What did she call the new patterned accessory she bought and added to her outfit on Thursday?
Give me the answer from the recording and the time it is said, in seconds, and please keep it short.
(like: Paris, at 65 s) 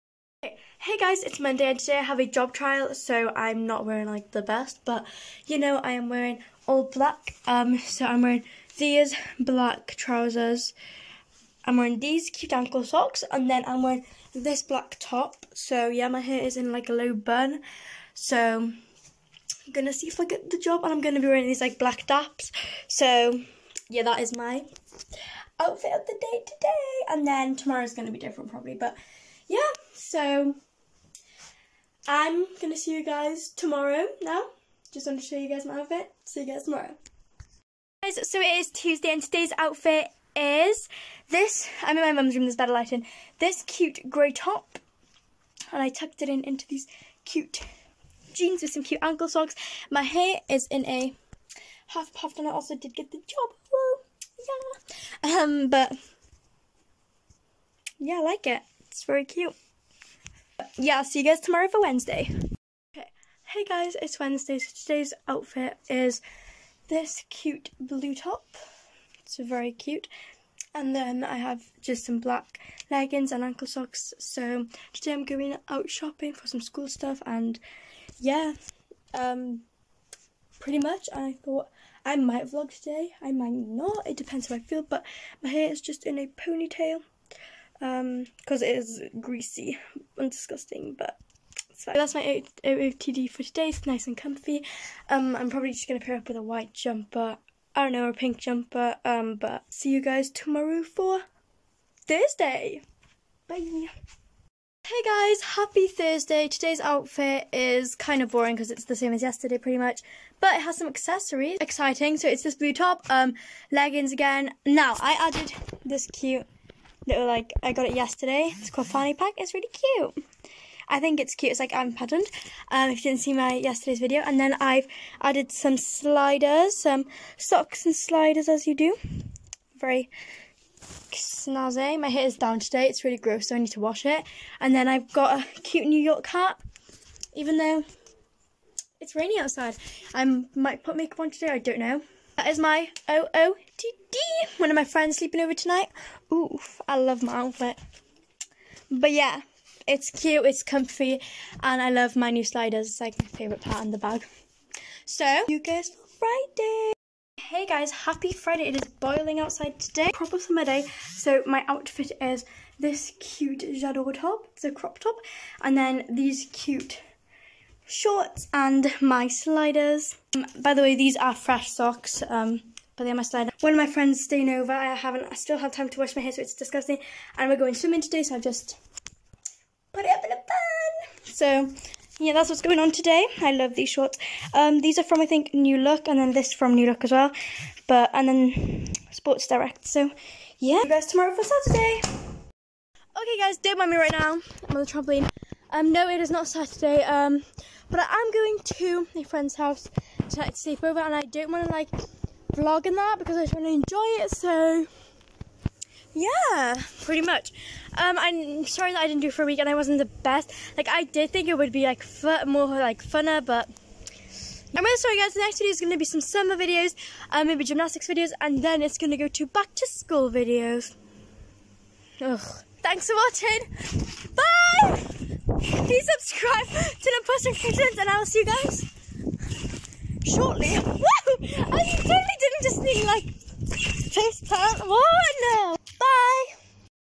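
Fanny Pack, at 118 s.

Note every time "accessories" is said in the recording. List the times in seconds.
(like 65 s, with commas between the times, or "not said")
110 s.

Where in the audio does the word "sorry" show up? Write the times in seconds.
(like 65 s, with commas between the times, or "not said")
208 s, 214 s.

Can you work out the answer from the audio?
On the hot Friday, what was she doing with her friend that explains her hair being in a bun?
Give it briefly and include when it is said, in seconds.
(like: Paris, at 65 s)
Swimming, at 177 s.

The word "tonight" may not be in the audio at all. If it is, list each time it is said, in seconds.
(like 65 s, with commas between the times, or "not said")
145 s, 200 s.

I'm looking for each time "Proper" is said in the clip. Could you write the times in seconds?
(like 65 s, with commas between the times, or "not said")
160 s.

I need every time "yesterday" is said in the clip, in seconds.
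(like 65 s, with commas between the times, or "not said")
109 s, 117 s, 123 s.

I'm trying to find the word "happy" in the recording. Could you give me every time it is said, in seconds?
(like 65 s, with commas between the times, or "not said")
105 s, 157 s.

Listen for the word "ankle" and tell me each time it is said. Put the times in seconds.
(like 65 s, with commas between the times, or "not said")
12 s, 49 s, 73 s.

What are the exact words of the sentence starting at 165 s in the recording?
And then these cute shorts and my sliders.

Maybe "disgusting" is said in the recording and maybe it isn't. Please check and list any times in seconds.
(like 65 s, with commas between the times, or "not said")
90 s, 176 s.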